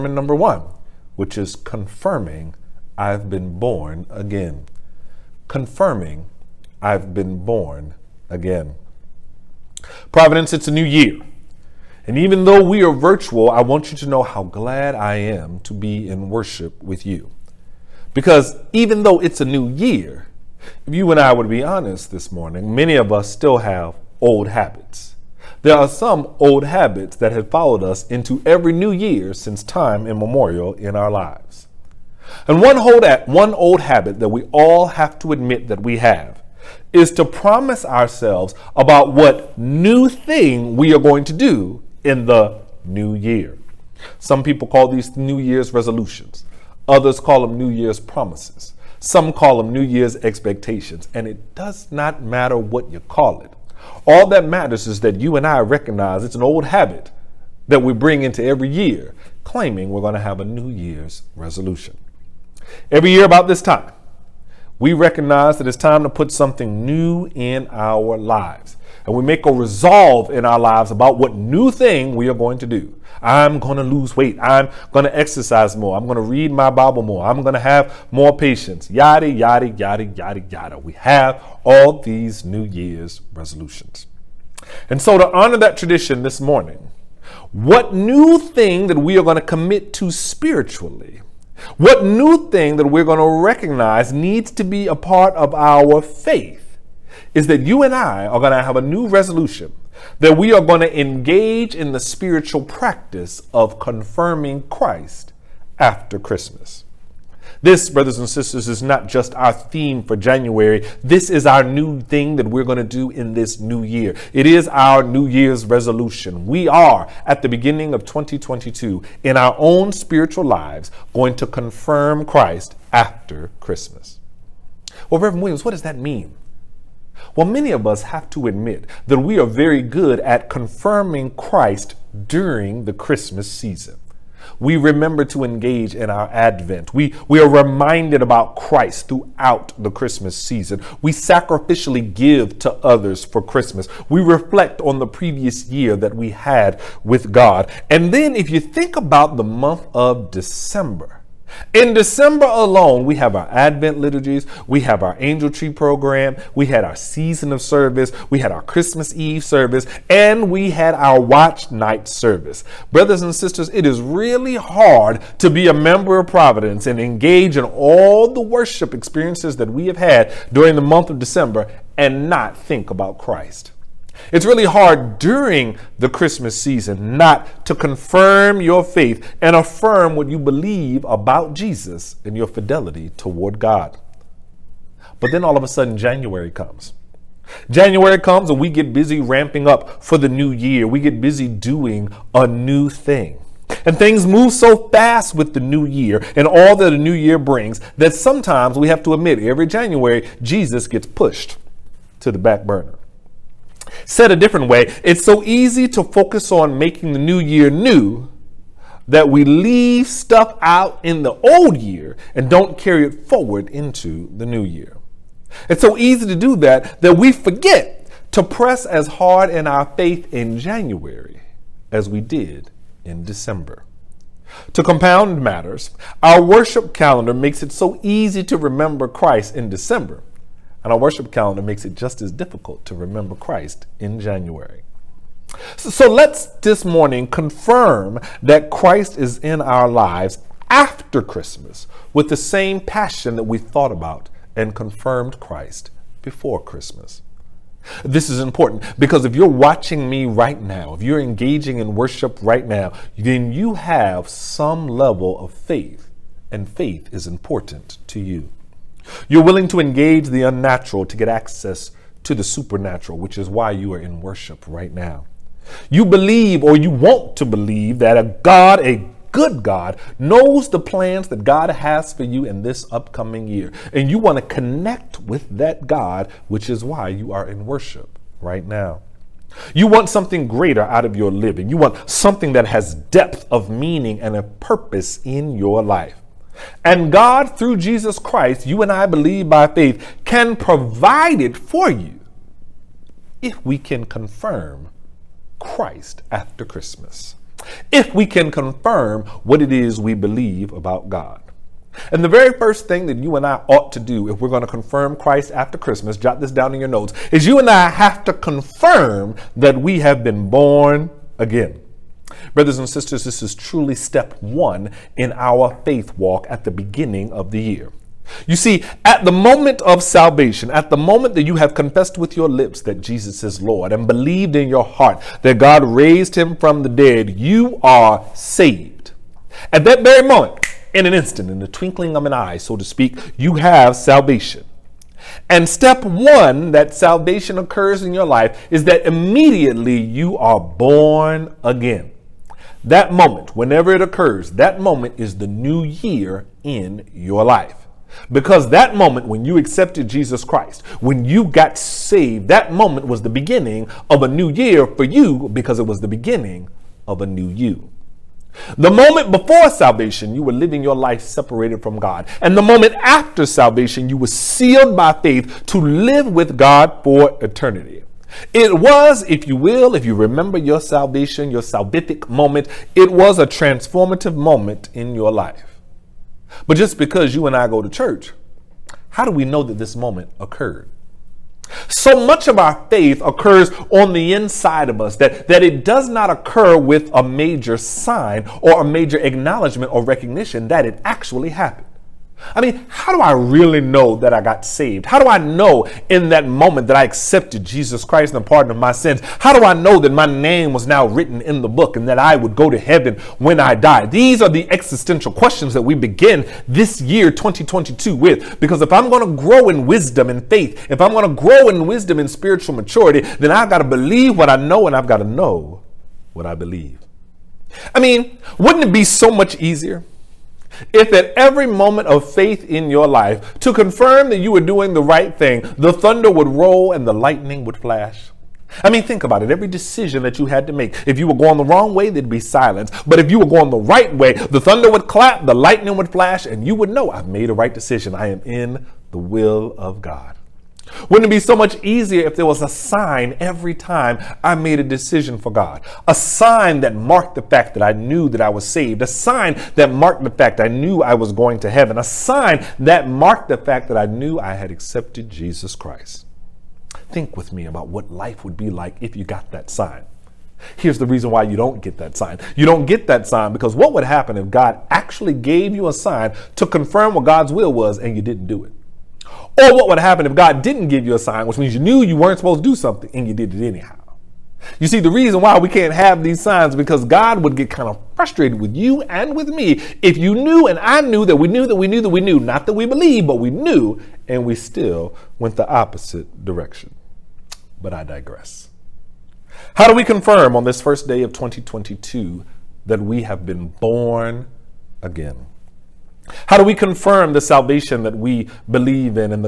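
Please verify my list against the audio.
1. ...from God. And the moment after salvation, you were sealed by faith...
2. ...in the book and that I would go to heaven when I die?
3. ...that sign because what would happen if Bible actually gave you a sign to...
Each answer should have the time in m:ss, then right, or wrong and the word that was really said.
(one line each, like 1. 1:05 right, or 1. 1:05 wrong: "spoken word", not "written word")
1. 6:01 right
2. 6:41 right
3. 7:43 wrong: "God", not "Bible".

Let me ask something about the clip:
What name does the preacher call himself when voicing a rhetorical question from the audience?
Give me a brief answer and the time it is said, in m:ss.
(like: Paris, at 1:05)
Reverend Williams, at 2:05.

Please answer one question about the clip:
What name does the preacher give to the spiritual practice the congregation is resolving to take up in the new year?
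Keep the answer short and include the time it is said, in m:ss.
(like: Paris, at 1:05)
Confirming Christ after Christmas, at 1:43.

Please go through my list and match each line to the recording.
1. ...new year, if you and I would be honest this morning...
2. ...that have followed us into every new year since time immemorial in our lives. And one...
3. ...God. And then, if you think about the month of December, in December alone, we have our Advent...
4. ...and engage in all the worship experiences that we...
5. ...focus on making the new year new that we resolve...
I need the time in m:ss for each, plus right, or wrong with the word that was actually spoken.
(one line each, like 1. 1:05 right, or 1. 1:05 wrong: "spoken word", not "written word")
1. 0:19 right
2. 0:27 right
3. 2:27 right
4. 2:46 right
5. 3:26 wrong: "leave", not "resolve".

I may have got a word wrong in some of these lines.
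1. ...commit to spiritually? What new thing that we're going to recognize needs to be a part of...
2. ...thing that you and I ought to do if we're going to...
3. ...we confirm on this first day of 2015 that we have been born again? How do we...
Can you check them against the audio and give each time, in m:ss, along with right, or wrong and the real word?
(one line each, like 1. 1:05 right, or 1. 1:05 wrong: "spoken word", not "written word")
1. 1:29 right
2. 5:02 right
3. 8:09 wrong: "2022", not "2015".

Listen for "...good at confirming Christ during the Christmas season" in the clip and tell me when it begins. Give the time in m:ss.
2:09.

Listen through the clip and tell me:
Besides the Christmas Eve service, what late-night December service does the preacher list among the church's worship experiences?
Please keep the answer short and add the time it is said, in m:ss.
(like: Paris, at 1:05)
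Watch night service, at 2:41.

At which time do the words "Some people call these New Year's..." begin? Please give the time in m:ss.
0:44.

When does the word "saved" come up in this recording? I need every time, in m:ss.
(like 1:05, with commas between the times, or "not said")
5:28, 5:51, 6:34, 7:28.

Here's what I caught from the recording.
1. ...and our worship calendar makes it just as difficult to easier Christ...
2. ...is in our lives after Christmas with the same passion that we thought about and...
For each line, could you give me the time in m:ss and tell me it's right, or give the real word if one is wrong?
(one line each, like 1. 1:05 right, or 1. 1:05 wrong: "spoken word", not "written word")
1. 3:50 wrong: "remember", not "easier"
2. 3:59 right.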